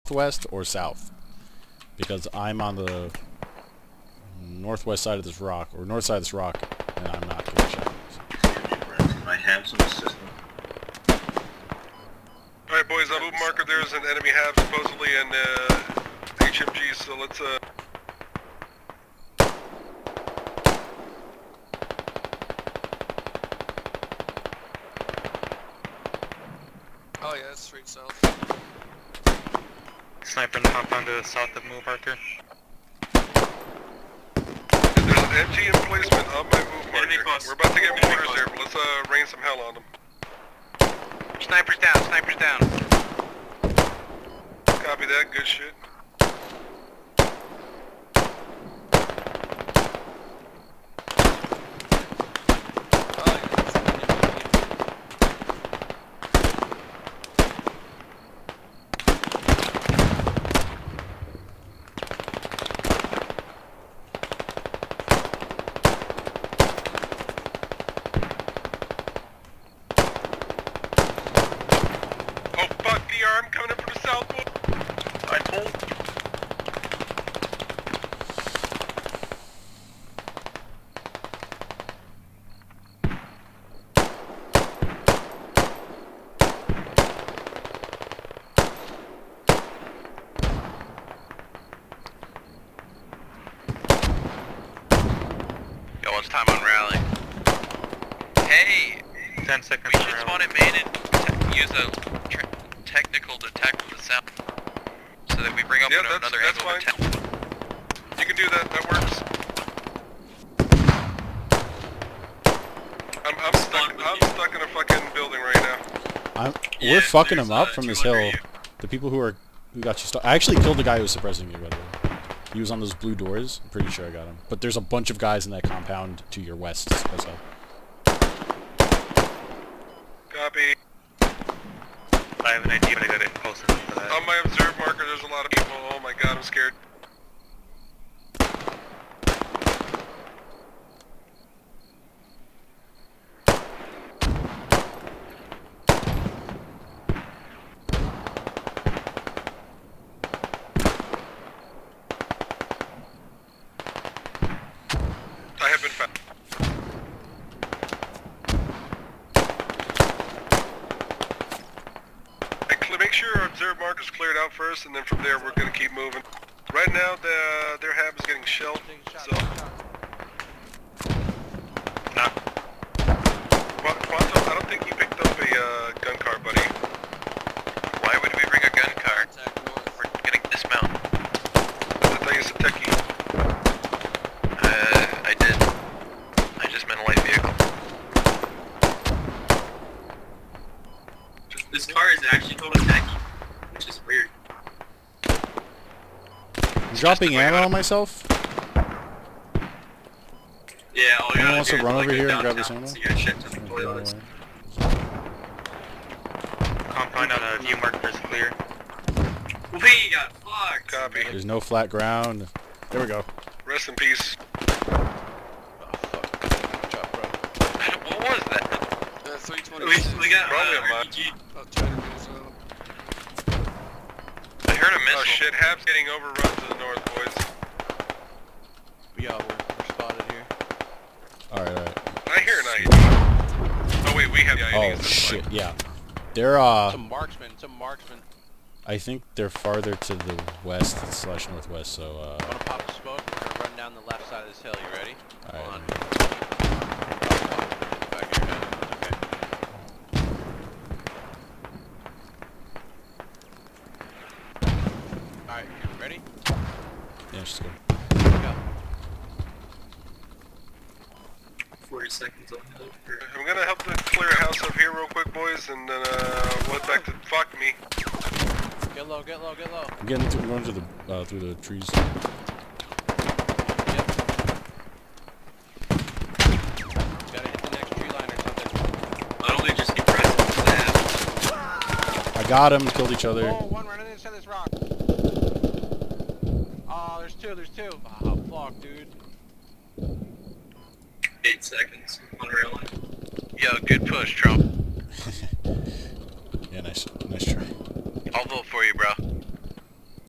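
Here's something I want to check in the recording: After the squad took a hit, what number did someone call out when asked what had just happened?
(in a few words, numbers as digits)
320.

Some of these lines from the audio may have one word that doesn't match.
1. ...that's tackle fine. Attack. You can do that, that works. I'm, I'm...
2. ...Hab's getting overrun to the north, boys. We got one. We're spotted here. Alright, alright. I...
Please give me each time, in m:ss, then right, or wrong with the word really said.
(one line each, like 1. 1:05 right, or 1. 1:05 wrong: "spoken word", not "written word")
1. 1:46 wrong: "angle", not "tackle"
2. 3:45 right.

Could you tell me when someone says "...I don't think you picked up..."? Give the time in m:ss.
2:54.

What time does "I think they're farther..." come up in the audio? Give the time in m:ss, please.
3:58.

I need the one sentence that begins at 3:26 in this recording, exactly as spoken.
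Compound on a view markers clear.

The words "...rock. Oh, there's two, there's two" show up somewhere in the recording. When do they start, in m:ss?
4:44.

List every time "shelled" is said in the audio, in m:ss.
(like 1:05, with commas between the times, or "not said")
2:48.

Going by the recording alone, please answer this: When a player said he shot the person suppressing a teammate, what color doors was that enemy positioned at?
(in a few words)
Blue.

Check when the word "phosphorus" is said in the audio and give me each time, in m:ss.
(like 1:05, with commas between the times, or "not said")
not said.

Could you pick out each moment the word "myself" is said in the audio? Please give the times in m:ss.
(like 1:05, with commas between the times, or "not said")
3:17.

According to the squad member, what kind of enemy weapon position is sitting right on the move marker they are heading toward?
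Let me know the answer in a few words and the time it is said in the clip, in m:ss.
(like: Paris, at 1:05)
MG emplacement, at 0:35.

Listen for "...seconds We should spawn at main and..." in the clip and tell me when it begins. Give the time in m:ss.
1:39.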